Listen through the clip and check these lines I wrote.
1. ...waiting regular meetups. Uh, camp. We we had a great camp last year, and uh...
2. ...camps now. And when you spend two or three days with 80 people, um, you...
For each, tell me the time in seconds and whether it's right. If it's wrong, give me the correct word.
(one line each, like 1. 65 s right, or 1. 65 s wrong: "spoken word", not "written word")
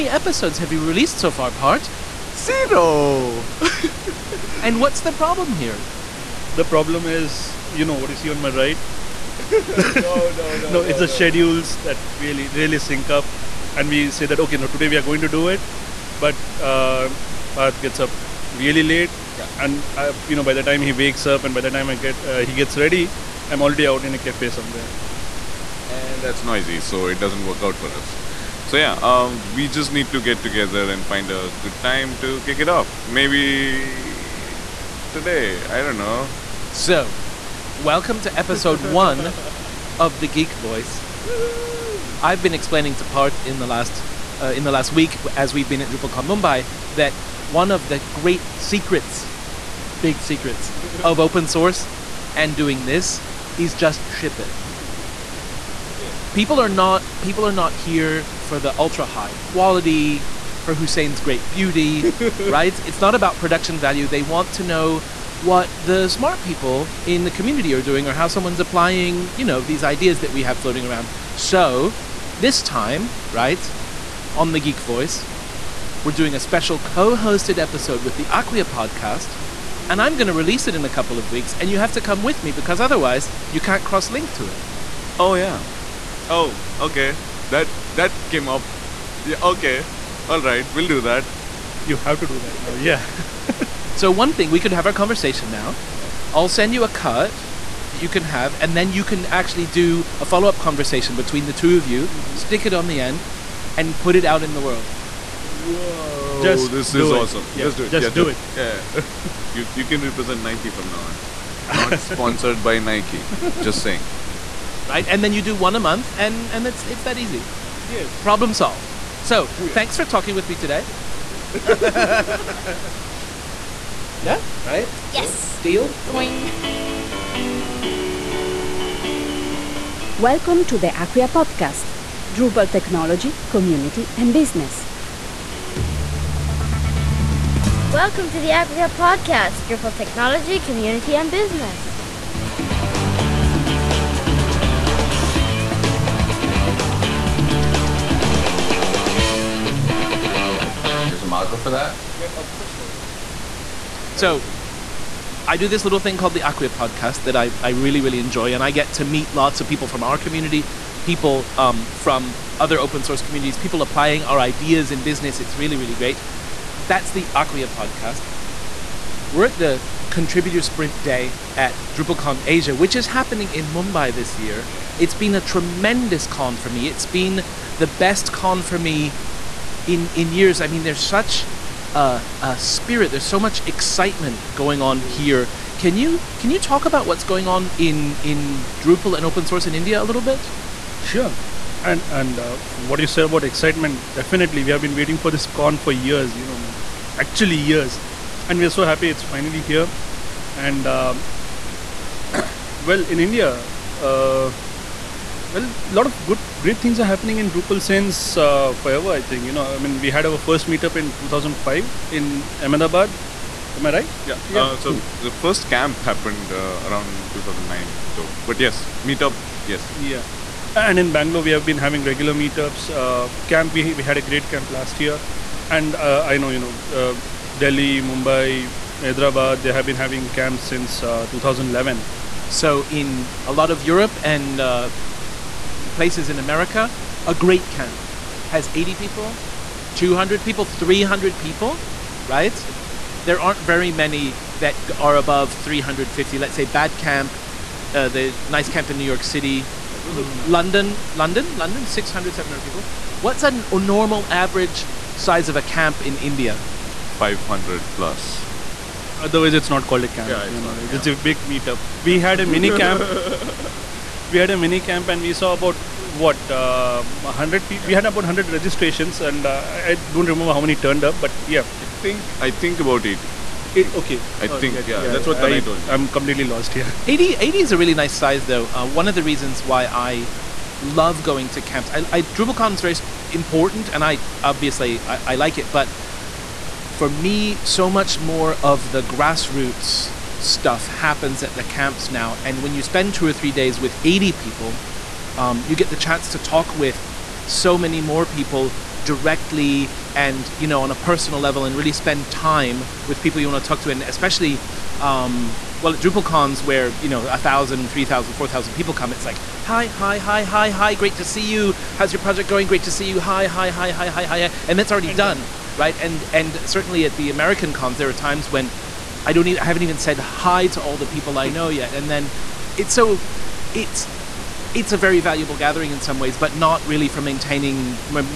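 1. 221 s wrong: "having", not "waiting"
2. 291 s right.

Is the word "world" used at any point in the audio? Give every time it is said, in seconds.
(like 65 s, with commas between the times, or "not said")
104 s.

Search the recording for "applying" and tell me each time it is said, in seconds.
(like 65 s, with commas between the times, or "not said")
68 s, 163 s.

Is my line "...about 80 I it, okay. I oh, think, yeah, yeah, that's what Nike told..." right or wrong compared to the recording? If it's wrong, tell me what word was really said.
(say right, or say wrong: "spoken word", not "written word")
wrong: "Tanai", not "Nike".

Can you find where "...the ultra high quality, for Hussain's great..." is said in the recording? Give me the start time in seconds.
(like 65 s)
58 s.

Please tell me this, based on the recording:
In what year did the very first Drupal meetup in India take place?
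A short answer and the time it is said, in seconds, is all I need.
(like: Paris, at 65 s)
2005, at 211 s.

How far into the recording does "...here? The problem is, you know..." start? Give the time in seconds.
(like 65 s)
5 s.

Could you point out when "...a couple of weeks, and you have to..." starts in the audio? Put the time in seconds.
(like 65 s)
80 s.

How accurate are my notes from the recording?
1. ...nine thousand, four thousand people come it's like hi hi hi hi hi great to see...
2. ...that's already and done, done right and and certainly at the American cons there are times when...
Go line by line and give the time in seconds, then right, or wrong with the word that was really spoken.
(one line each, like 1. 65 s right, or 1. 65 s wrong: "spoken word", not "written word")
1. 307 s wrong: "three", not "nine"
2. 314 s right.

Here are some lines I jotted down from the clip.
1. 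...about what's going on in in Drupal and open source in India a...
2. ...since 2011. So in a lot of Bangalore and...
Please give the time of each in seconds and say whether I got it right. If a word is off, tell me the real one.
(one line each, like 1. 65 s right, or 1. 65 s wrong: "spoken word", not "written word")
1. 186 s right
2. 230 s wrong: "Europe", not "Bangalore".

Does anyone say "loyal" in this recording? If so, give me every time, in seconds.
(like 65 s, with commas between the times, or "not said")
not said.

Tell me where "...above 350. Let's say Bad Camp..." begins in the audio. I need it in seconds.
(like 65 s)
245 s.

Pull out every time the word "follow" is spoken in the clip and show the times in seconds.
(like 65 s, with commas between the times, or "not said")
100 s.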